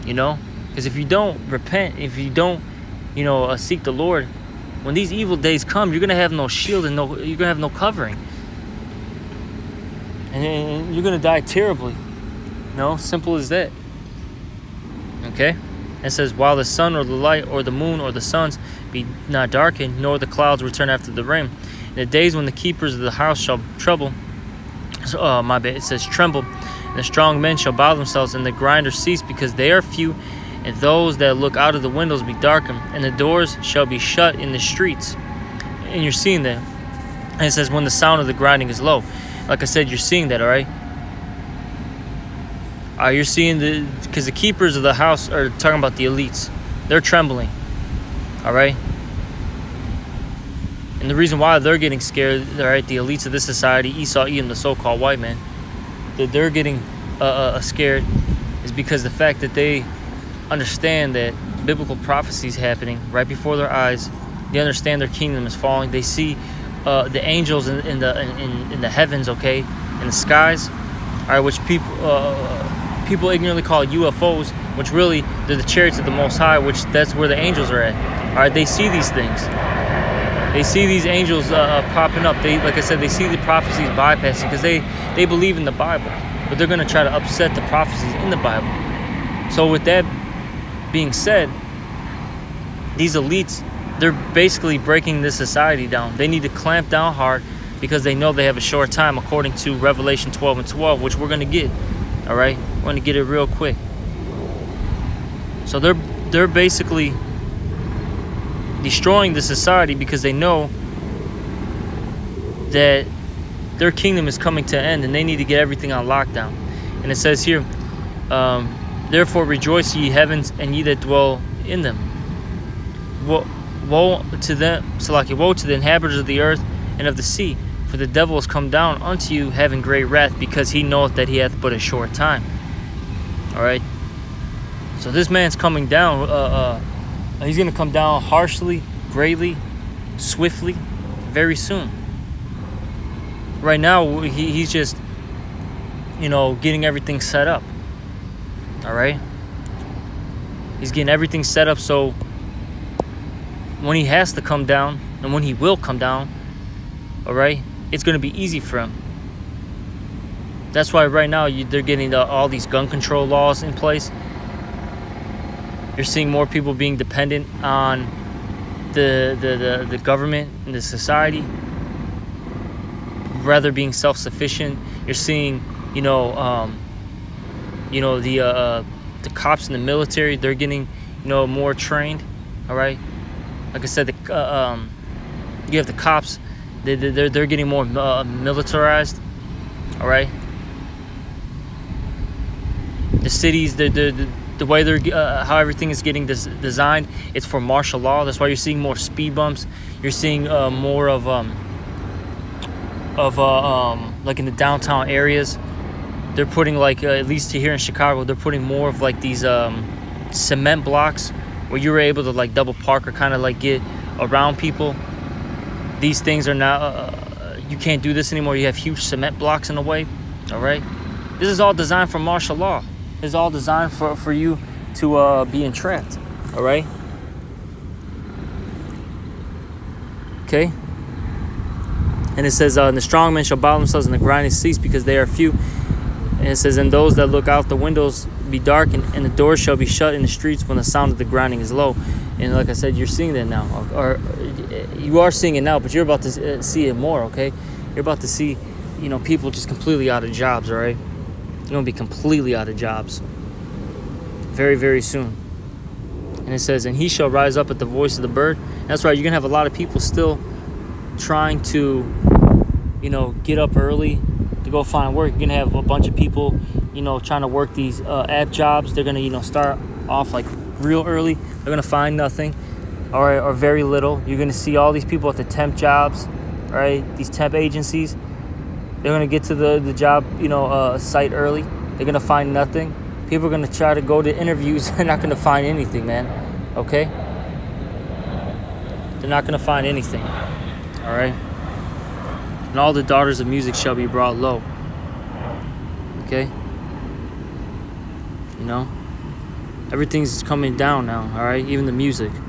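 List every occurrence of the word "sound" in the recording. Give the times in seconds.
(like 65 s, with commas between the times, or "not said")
37 s, 240 s.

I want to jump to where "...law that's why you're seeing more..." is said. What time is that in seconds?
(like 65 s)
197 s.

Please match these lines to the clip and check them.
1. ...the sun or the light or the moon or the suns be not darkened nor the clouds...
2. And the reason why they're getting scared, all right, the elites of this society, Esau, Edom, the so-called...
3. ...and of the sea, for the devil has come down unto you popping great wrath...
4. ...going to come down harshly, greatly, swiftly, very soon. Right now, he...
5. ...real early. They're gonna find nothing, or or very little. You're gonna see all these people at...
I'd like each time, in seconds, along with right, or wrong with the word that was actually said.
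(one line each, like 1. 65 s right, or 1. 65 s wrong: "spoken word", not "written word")
1. 16 s right
2. 50 s right
3. 126 s wrong: "having", not "popping"
4. 137 s right
5. 270 s right.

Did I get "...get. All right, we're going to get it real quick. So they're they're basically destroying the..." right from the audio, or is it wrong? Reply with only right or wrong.
right.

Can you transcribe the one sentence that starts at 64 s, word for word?
They understand their kingdom is falling.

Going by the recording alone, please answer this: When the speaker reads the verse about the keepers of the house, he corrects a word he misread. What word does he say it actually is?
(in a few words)
tremble.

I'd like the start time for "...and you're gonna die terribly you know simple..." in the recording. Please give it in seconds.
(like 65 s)
10 s.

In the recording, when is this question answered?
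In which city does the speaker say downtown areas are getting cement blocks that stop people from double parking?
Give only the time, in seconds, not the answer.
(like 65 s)
207 s.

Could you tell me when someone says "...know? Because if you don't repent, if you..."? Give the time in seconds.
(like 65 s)
0 s.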